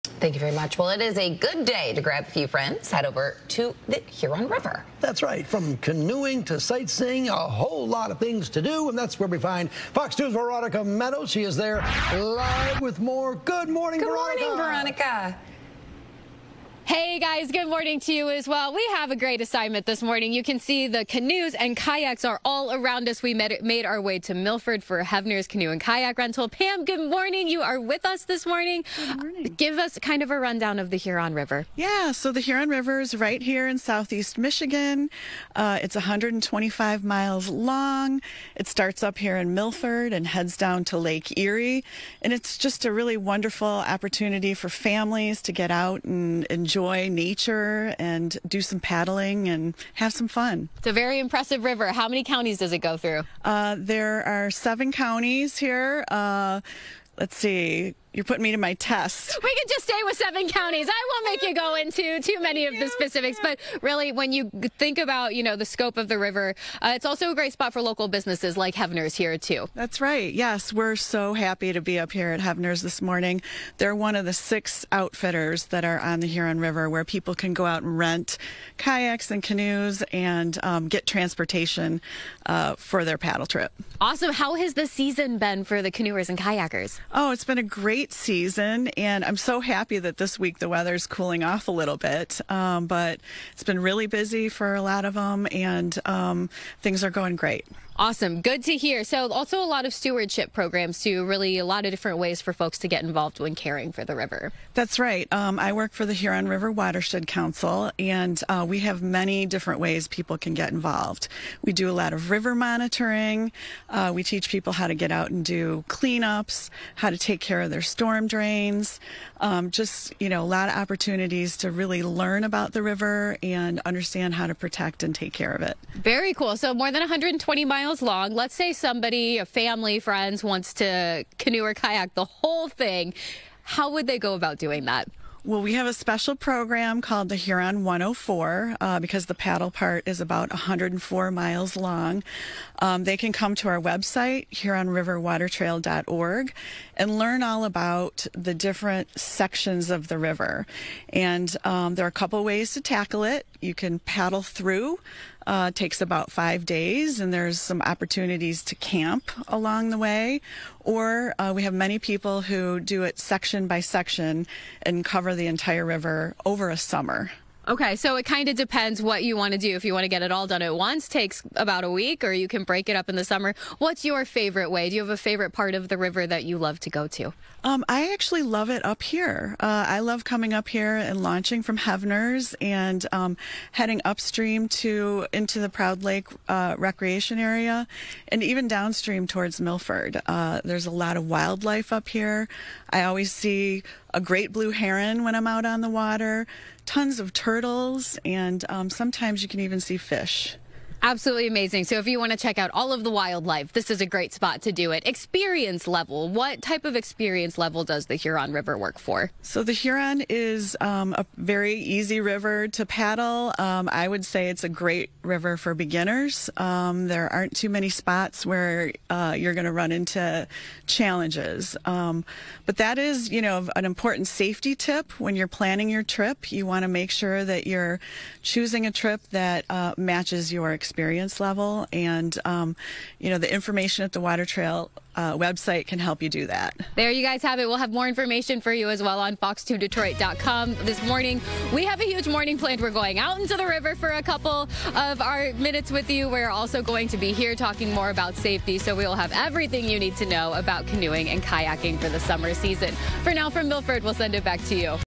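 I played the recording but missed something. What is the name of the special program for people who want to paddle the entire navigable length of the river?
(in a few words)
Huron 104.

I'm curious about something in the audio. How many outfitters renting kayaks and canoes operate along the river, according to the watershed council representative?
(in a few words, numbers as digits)
6.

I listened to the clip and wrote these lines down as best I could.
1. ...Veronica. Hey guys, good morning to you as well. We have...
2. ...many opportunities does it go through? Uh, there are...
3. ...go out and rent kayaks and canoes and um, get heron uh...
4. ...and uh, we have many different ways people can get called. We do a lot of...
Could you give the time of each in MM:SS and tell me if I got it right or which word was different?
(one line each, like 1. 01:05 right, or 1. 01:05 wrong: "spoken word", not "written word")
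1. 00:14 right
2. 00:52 wrong: "counties", not "opportunities"
3. 01:17 wrong: "transportation", not "heron"
4. 01:47 wrong: "involved", not "called".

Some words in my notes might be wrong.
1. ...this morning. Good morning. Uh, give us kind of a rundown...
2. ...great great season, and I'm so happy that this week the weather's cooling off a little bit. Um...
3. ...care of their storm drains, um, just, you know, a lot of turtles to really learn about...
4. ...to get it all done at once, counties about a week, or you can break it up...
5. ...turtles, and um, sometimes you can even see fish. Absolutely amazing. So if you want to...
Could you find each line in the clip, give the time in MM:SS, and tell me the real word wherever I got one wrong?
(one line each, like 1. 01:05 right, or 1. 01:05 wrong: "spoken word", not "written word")
1. 00:28 right
2. 01:27 right
3. 01:57 wrong: "opportunities", not "turtles"
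4. 02:50 wrong: "takes", not "counties"
5. 03:17 right.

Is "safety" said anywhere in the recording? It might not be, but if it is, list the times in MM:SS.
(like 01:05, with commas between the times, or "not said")
03:44, 04:08.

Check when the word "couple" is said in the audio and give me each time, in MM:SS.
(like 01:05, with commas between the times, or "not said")
02:32, 04:04.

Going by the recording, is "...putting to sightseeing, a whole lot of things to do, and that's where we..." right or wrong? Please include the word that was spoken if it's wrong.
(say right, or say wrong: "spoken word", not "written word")
wrong: "canoeing", not "putting".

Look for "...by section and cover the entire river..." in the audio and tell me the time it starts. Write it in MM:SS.
02:43.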